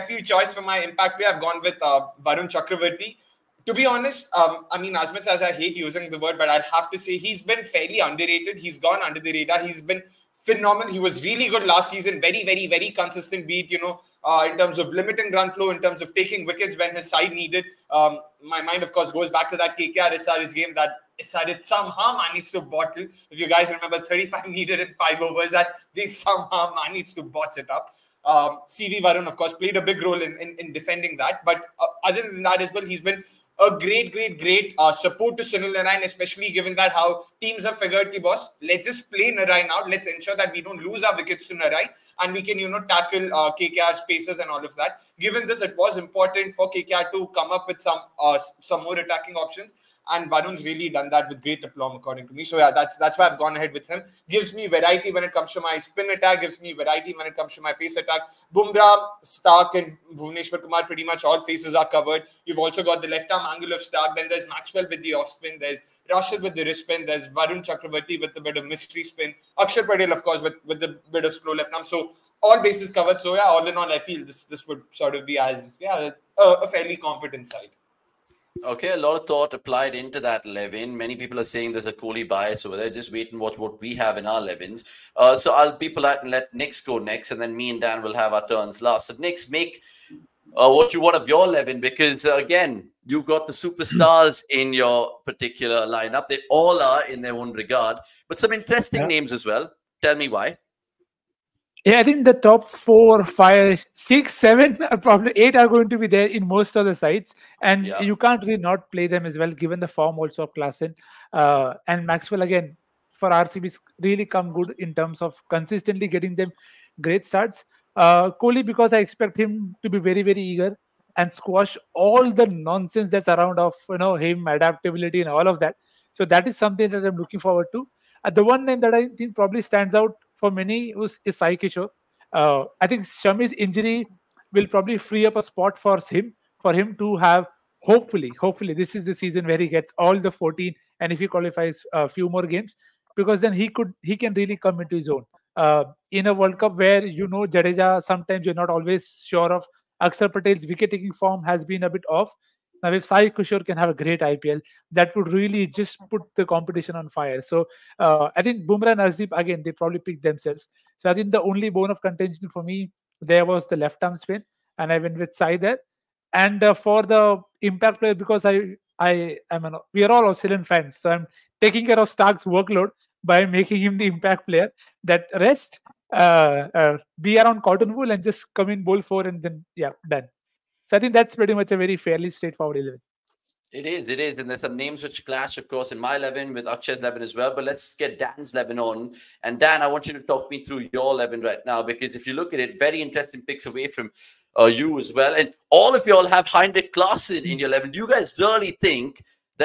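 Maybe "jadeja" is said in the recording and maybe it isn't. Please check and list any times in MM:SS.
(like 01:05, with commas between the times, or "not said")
02:27.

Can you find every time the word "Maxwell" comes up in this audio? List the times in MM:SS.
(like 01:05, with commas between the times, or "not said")
01:04, 01:52.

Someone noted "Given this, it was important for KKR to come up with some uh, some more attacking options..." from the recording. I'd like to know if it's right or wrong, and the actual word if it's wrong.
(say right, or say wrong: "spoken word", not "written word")
right.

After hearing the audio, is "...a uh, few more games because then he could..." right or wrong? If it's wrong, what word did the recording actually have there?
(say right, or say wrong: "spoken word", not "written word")
right.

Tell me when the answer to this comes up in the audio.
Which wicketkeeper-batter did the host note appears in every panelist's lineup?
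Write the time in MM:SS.
03:16.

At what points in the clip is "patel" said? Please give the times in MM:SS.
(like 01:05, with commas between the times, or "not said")
01:09, 02:30.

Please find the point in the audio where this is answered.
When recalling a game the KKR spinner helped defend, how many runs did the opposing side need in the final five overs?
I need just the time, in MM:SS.
00:24.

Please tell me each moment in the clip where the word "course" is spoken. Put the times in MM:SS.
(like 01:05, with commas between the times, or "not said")
00:18, 00:29, 01:10, 03:05.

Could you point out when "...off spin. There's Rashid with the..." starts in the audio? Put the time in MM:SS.
01:05.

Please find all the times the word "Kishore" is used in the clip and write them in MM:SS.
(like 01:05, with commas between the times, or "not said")
02:11, 02:33.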